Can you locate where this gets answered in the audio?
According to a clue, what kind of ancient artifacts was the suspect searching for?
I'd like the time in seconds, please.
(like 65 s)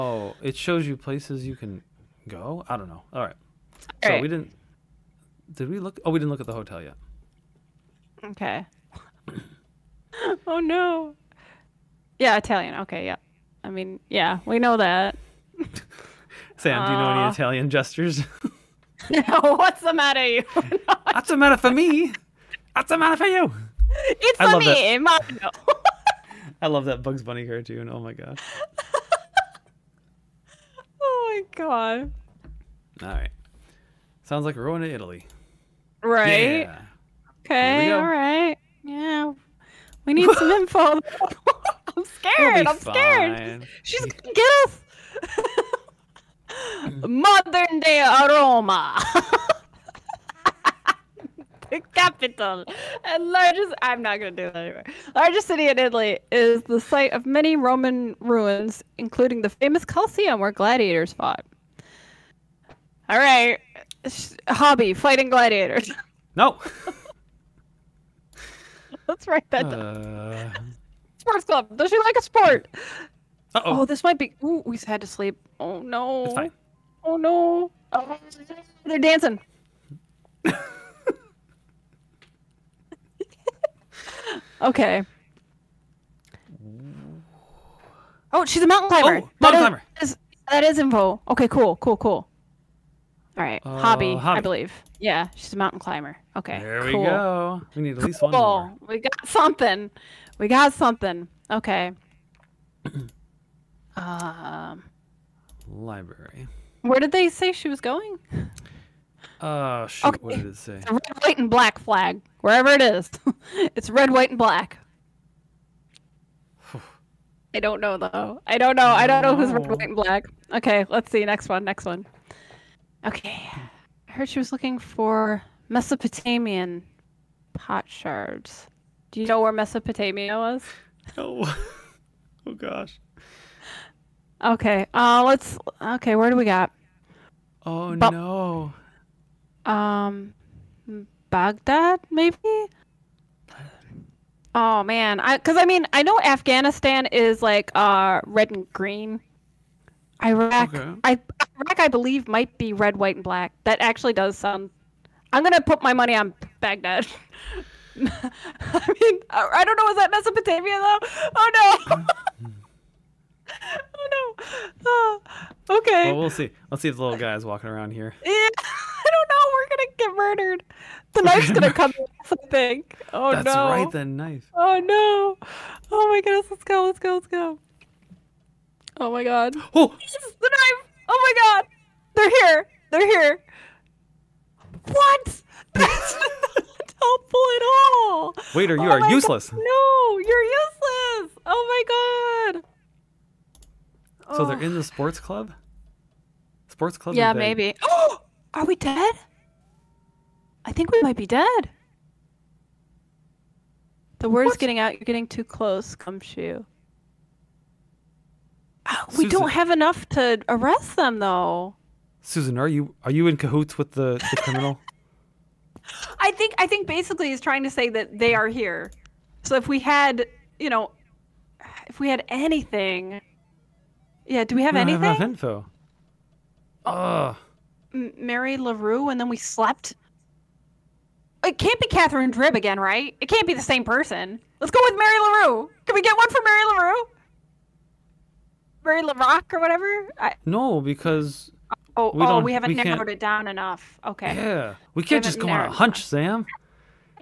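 125 s.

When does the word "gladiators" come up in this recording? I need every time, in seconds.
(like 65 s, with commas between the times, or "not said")
60 s, 65 s.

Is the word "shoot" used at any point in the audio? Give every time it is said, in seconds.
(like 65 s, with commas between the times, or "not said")
109 s.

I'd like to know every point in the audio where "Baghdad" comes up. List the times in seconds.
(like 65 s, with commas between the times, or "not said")
141 s, 156 s.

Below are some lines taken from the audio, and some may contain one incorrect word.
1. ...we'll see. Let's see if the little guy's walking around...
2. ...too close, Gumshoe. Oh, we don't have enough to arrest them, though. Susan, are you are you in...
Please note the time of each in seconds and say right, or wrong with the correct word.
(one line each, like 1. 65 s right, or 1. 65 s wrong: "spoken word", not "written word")
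1. 166 s right
2. 205 s right.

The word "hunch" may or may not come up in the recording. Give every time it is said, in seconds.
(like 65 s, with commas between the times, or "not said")
245 s.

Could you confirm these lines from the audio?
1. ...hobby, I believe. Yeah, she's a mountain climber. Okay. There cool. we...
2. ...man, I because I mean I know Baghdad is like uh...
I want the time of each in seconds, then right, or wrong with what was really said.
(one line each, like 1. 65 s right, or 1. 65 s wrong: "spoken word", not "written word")
1. 94 s right
2. 144 s wrong: "Afghanistan", not "Baghdad".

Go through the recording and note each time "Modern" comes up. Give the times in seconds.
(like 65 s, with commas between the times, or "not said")
47 s.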